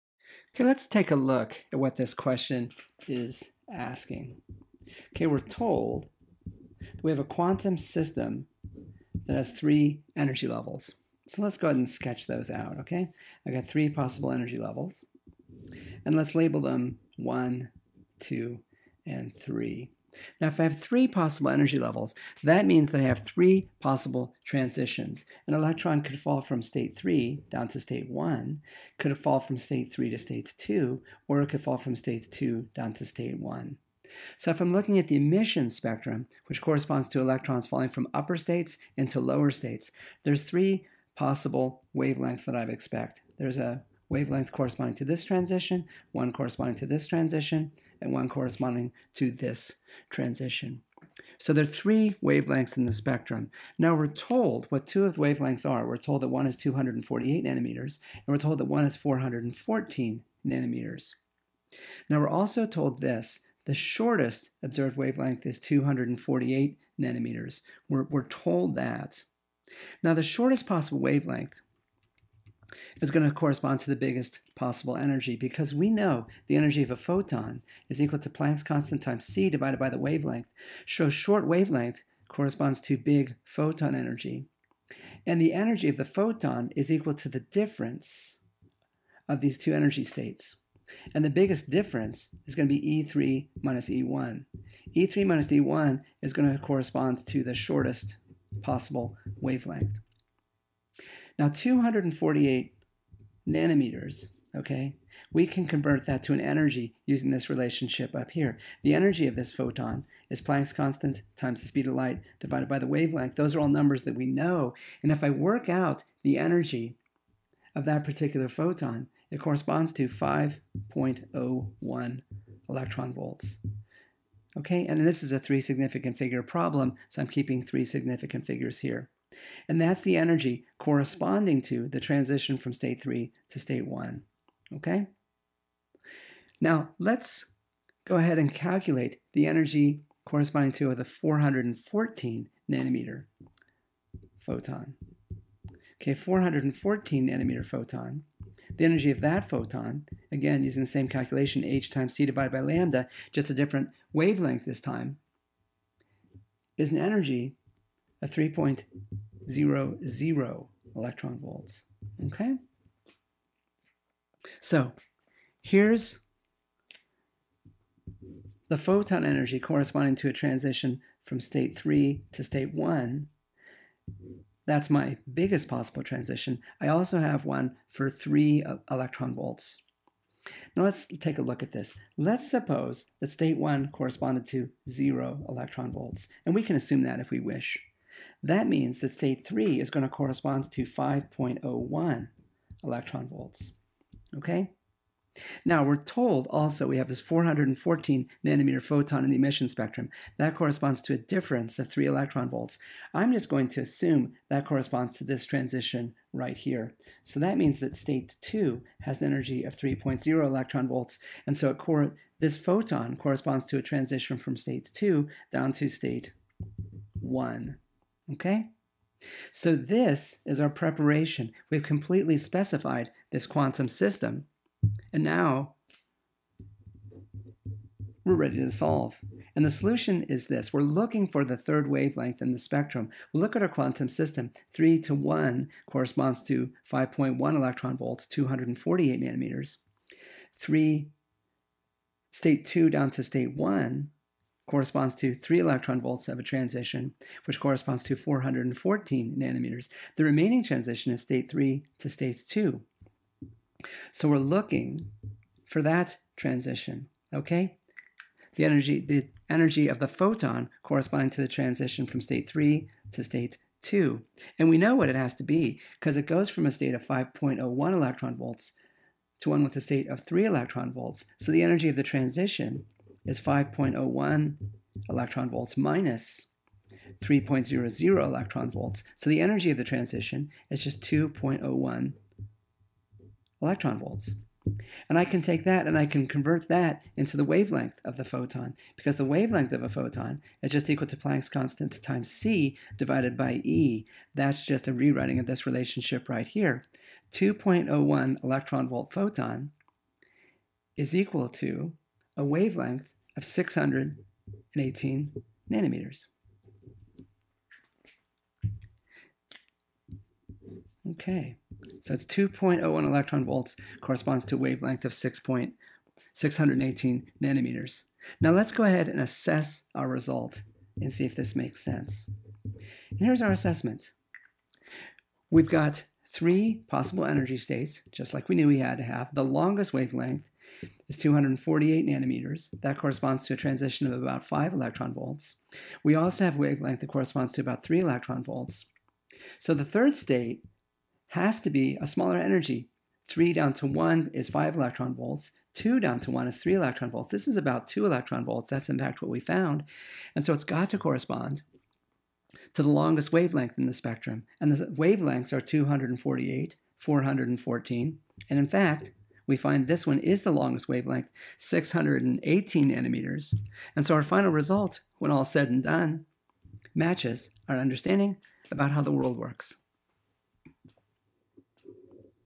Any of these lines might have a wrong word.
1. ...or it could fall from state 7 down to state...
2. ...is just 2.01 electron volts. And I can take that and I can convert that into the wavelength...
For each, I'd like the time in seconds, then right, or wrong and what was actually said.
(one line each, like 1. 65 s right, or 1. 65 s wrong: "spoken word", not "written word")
1. 31 s wrong: "2", not "7"
2. 280 s right.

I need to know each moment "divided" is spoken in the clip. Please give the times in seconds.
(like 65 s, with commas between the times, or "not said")
79 s, 112 s, 152 s, 292 s.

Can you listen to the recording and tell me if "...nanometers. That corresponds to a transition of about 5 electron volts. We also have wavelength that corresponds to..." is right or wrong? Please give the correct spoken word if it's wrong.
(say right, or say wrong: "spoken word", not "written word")
right.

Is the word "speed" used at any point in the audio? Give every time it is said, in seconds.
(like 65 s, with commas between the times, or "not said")
111 s.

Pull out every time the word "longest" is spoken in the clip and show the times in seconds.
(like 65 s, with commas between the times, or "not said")
329 s, 352 s, 360 s.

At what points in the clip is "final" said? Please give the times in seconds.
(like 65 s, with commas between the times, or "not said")
364 s.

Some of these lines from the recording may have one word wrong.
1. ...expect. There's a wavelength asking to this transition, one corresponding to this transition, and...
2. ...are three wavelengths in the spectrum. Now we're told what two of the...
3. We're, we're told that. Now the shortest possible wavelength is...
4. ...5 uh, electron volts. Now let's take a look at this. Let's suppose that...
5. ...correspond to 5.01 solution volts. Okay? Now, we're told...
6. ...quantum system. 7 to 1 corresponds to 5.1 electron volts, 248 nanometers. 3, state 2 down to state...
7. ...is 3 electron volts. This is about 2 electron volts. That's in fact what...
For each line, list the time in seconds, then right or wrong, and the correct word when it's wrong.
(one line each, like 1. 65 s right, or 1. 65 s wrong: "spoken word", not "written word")
1. 42 s wrong: "corresponding", not "asking"
2. 51 s right
3. 67 s right
4. 178 s wrong: "3", not "5"
5. 190 s wrong: "electron", not "solution"
6. 233 s wrong: "3", not "7"
7. 346 s right.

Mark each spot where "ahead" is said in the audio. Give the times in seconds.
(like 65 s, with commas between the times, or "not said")
11 s, 138 s, 318 s.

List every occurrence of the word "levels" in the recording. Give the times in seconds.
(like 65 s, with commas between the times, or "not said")
10 s, 14 s, 21 s.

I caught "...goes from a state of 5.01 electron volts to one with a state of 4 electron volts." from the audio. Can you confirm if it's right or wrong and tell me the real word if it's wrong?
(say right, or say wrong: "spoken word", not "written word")
wrong: "3", not "4".